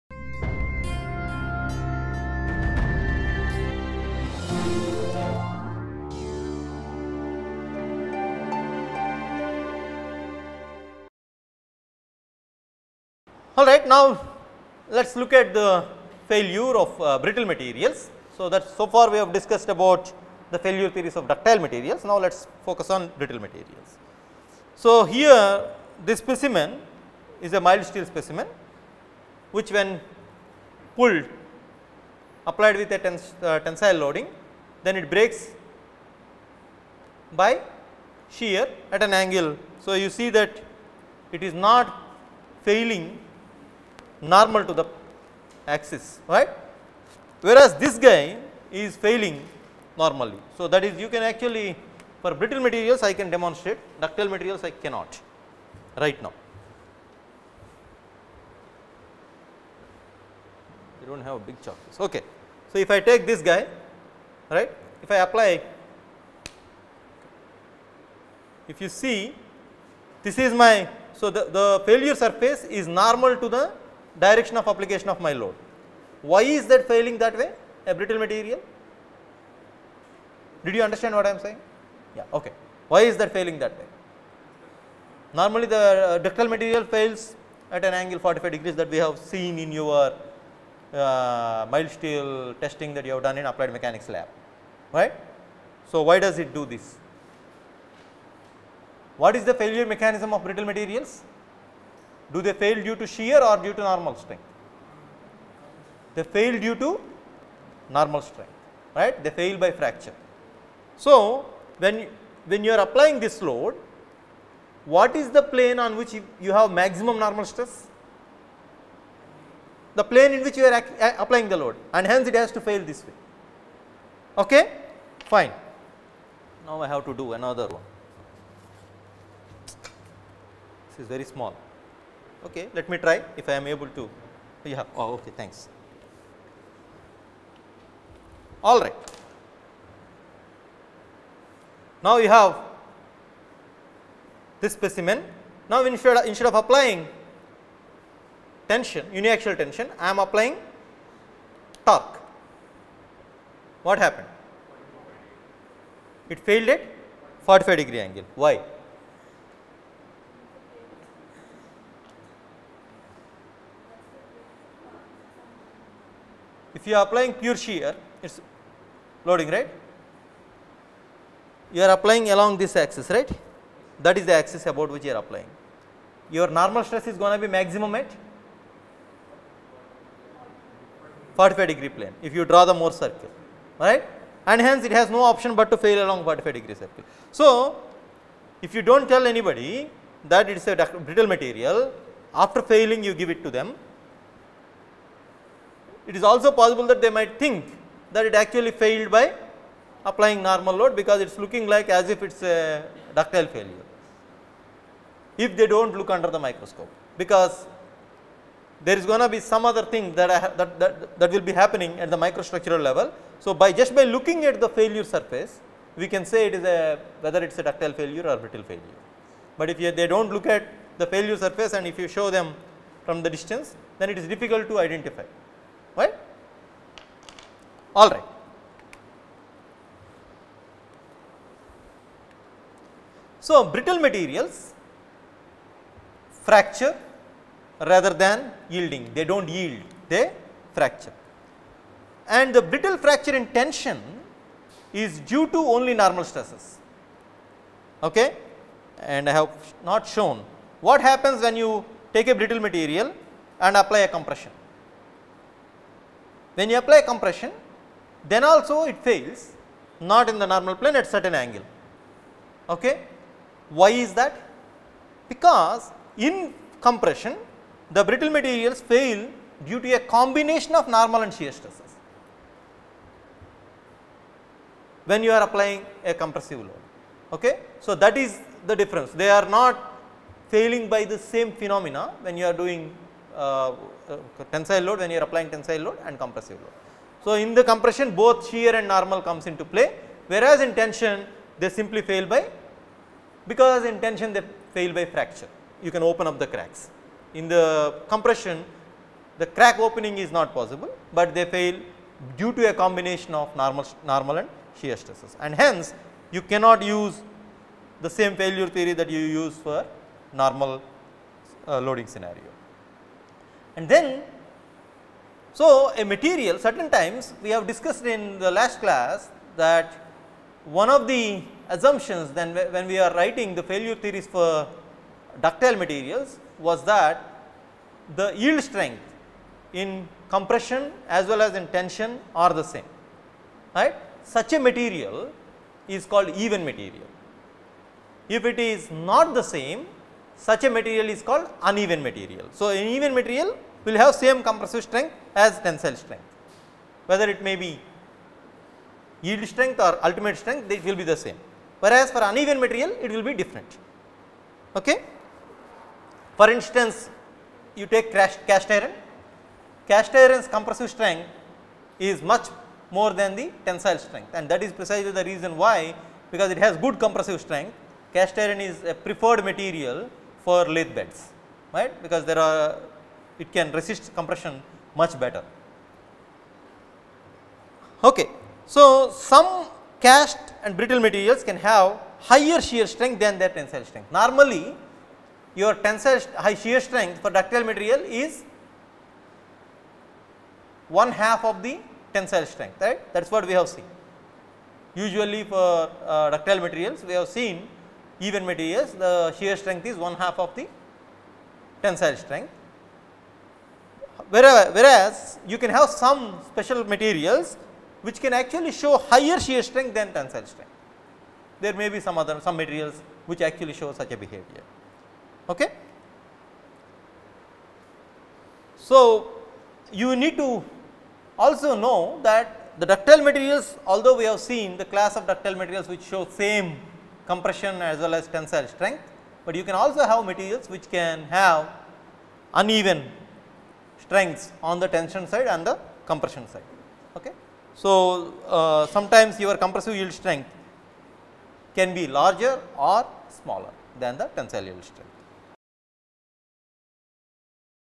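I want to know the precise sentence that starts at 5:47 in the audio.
Whether it may be yield strength or ultimate strength it will be the same, whereas for uneven material it will be different.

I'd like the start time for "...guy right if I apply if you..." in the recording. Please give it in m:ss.
1:03.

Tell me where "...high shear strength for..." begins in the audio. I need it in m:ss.
6:26.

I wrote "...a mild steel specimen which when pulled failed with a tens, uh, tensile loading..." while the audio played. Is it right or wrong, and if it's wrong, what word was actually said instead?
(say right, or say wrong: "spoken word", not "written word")
wrong: "applied", not "failed".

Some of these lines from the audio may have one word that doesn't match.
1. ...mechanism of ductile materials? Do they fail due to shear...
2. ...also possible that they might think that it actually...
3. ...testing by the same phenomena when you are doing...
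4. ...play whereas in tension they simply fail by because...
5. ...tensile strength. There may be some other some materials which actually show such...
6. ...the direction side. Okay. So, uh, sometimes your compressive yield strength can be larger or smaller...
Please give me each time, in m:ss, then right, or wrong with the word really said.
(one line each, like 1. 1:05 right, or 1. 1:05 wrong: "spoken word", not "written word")
1. 1:39 wrong: "brittle", not "ductile"
2. 3:16 right
3. 4:40 wrong: "failing", not "testing"
4. 4:49 right
5. 6:50 right
6. 7:15 wrong: "compression", not "direction".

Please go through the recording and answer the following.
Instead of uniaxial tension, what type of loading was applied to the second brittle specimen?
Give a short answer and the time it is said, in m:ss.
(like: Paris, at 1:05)
torque, at 2:31.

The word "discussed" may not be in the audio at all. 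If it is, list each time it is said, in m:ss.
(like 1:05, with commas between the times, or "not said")
0:19, 5:17.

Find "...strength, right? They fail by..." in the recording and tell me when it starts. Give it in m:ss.
1:48.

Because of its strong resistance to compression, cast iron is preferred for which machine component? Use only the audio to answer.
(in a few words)
lathe beds.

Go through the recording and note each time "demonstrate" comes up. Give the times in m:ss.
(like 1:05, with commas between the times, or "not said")
0:53.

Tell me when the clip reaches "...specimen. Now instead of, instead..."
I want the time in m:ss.
2:24.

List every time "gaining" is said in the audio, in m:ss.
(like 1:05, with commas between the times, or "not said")
not said.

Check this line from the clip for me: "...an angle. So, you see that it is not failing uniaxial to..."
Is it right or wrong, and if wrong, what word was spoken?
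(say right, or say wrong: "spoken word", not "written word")
wrong: "normal", not "uniaxial".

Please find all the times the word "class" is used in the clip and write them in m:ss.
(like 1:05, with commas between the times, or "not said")
5:18, 7:04.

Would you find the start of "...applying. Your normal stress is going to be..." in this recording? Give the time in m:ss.
2:55.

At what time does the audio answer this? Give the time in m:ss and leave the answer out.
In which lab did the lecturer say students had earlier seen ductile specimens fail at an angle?
1:33.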